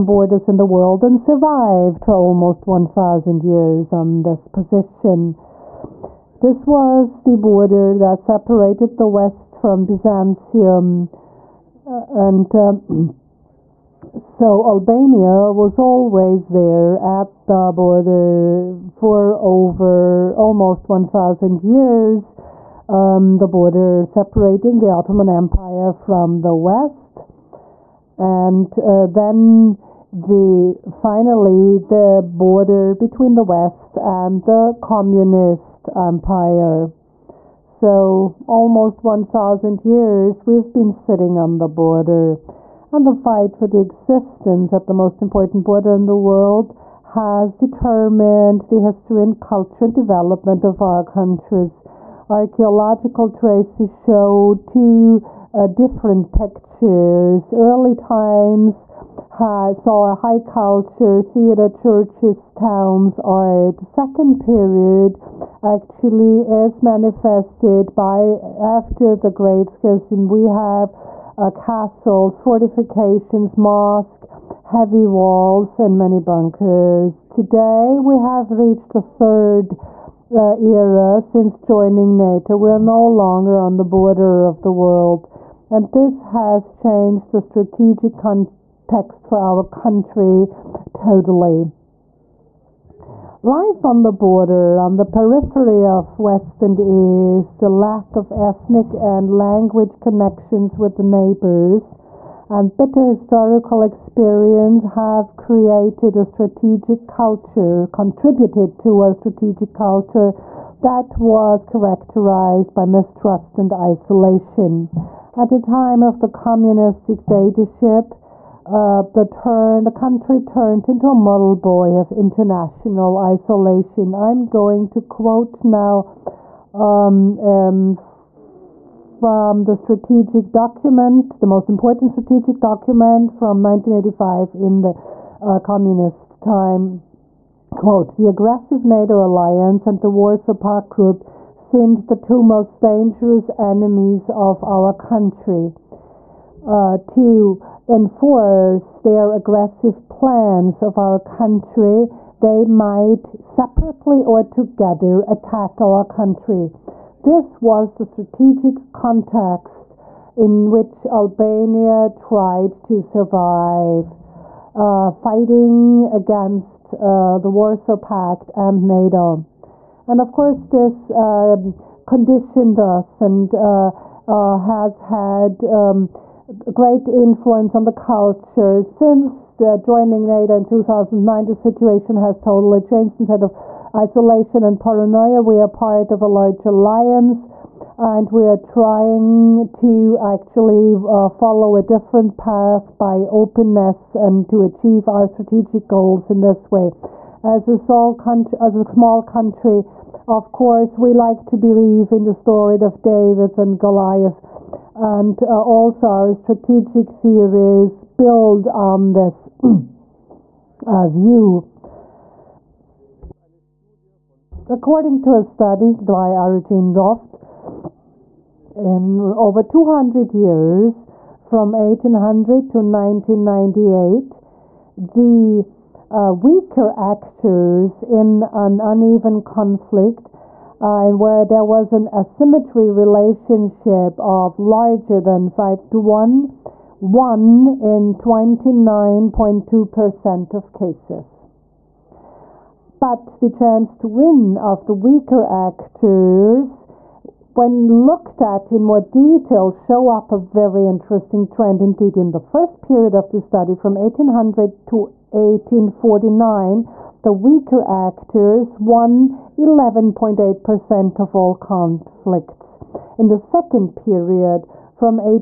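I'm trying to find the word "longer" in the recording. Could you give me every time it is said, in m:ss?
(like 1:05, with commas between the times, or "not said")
1:23.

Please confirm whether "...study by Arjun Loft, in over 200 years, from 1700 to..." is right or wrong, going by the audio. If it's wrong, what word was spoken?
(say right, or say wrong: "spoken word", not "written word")
wrong: "1800", not "1700".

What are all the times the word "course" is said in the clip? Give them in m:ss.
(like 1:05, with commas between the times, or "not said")
2:50, 3:20.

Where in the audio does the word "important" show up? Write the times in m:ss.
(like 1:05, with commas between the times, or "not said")
0:45, 2:11.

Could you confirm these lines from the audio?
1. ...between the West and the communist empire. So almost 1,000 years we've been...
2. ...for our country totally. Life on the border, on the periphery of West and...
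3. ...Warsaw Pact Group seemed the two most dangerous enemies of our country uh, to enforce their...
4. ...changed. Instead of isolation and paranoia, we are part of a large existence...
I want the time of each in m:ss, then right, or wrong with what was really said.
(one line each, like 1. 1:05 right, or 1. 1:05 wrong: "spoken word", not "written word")
1. 0:32 right
2. 1:29 right
3. 2:20 right
4. 3:02 wrong: "alliance", not "existence".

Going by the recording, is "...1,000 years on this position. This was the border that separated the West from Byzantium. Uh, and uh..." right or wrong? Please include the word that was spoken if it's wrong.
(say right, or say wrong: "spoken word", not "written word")
right.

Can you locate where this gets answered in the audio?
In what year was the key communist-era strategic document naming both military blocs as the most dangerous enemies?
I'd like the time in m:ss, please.
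2:13.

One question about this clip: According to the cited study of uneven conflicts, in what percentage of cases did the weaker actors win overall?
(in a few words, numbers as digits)
29.2%.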